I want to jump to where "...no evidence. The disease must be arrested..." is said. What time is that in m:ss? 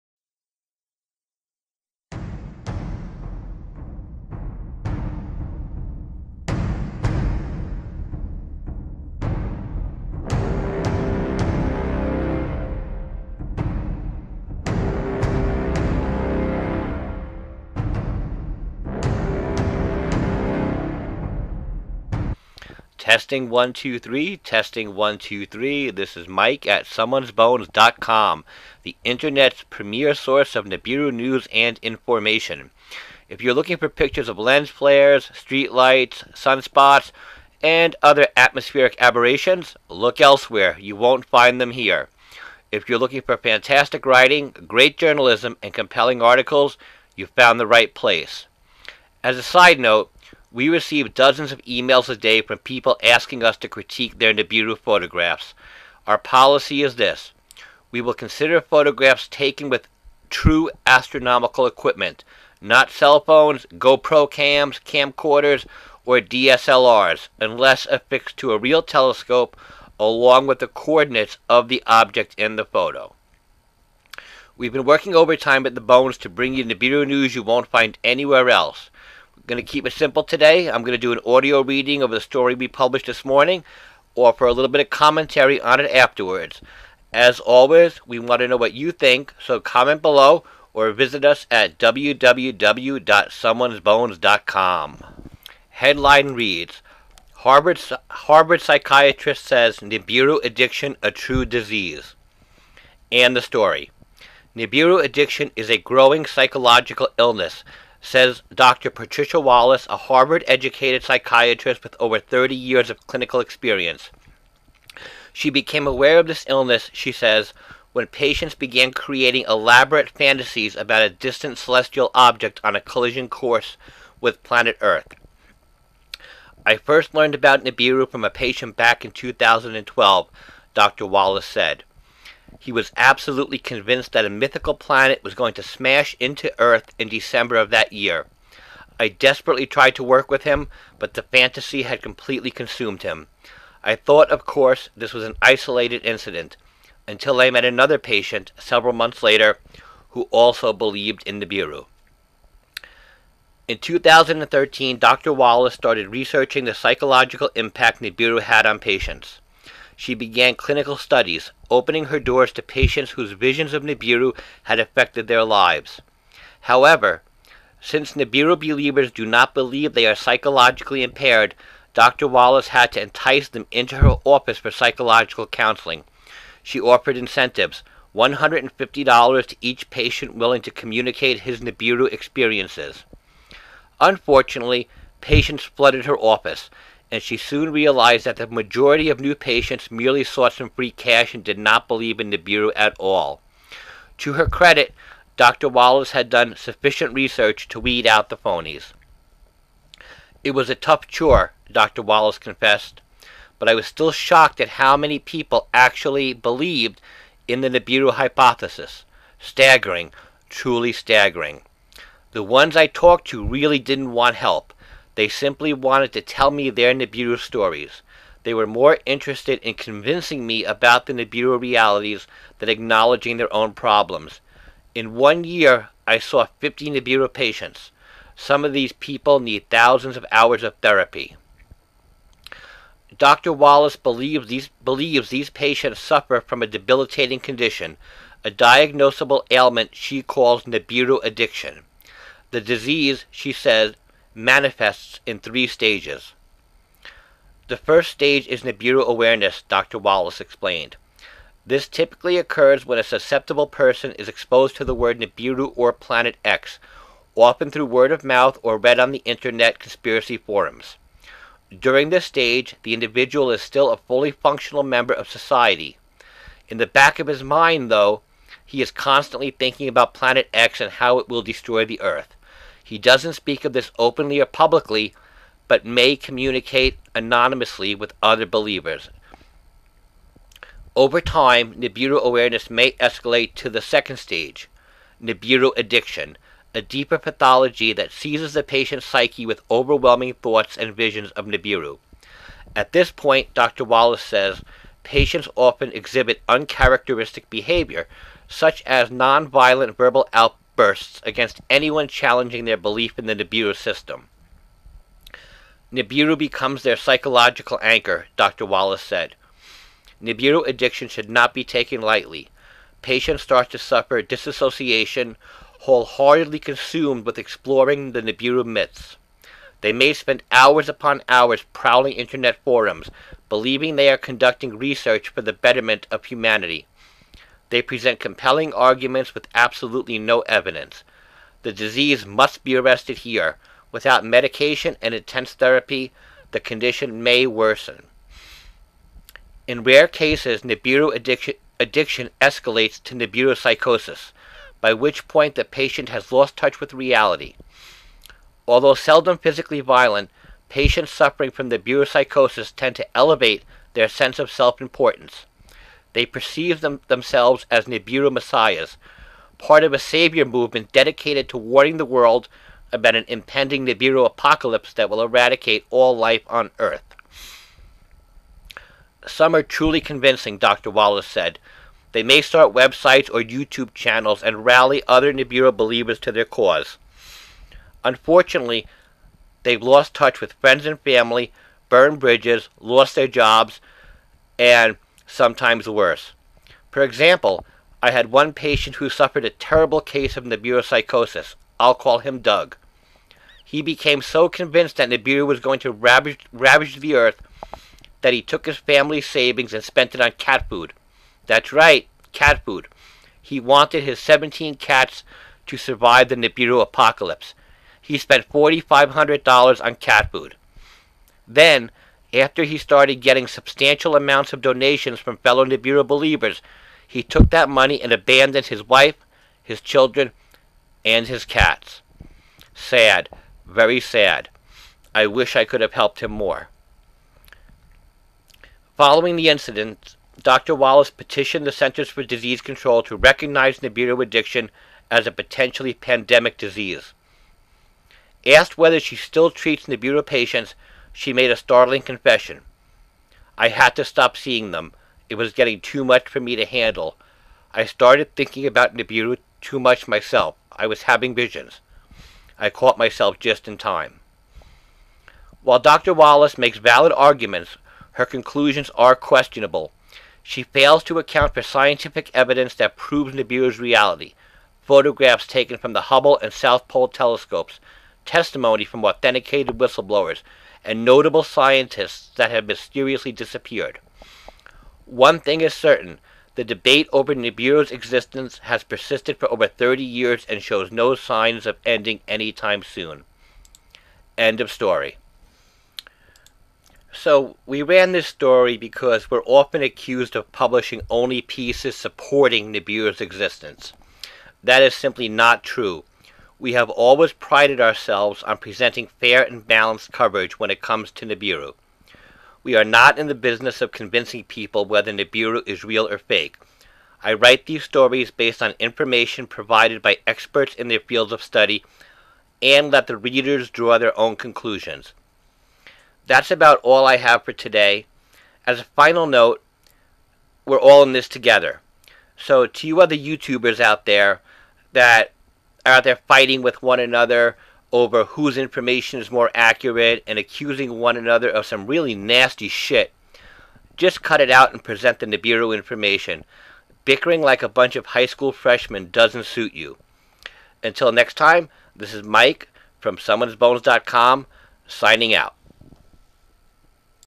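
5:30.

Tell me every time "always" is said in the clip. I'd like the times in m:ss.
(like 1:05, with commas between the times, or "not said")
1:27, 8:16.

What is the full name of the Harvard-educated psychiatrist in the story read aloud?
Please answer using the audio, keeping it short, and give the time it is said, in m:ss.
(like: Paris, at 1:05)
Patricia Wallace, at 1:48.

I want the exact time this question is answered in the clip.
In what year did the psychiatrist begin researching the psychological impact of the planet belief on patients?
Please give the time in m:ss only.
2:33.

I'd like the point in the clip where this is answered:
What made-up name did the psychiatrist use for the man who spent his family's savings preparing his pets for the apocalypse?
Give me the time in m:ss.
6:32.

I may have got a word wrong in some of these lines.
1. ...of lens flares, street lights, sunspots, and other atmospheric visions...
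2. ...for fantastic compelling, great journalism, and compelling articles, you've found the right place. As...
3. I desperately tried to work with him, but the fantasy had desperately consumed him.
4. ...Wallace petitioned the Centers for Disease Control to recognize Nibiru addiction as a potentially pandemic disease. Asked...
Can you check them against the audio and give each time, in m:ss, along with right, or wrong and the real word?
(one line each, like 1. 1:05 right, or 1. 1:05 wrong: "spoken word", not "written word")
1. 0:34 wrong: "aberrations", not "visions"
2. 0:43 wrong: "writing", not "compelling"
3. 2:18 wrong: "completely", not "desperately"
4. 7:10 right.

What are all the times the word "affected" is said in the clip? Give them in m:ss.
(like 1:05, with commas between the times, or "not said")
2:44.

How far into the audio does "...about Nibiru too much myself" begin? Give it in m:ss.
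7:28.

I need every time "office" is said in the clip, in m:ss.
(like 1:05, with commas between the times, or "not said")
2:54, 3:06.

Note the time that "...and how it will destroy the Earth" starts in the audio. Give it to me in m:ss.
4:30.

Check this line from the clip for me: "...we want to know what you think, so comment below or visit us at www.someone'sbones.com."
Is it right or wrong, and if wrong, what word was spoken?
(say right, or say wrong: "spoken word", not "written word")
right.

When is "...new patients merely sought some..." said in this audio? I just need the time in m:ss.
3:09.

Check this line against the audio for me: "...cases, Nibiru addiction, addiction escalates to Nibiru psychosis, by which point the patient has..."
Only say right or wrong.
right.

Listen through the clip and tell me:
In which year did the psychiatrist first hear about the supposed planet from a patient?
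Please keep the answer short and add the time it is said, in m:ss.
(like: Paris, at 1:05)
2012, at 2:09.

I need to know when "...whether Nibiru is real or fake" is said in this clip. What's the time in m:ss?
8:24.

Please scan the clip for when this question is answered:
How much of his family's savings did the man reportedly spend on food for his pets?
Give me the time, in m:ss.
6:48.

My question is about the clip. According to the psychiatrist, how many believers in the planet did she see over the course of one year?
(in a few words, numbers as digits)
50.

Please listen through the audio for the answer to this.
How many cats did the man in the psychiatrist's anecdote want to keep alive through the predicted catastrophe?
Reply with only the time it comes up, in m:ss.
6:44.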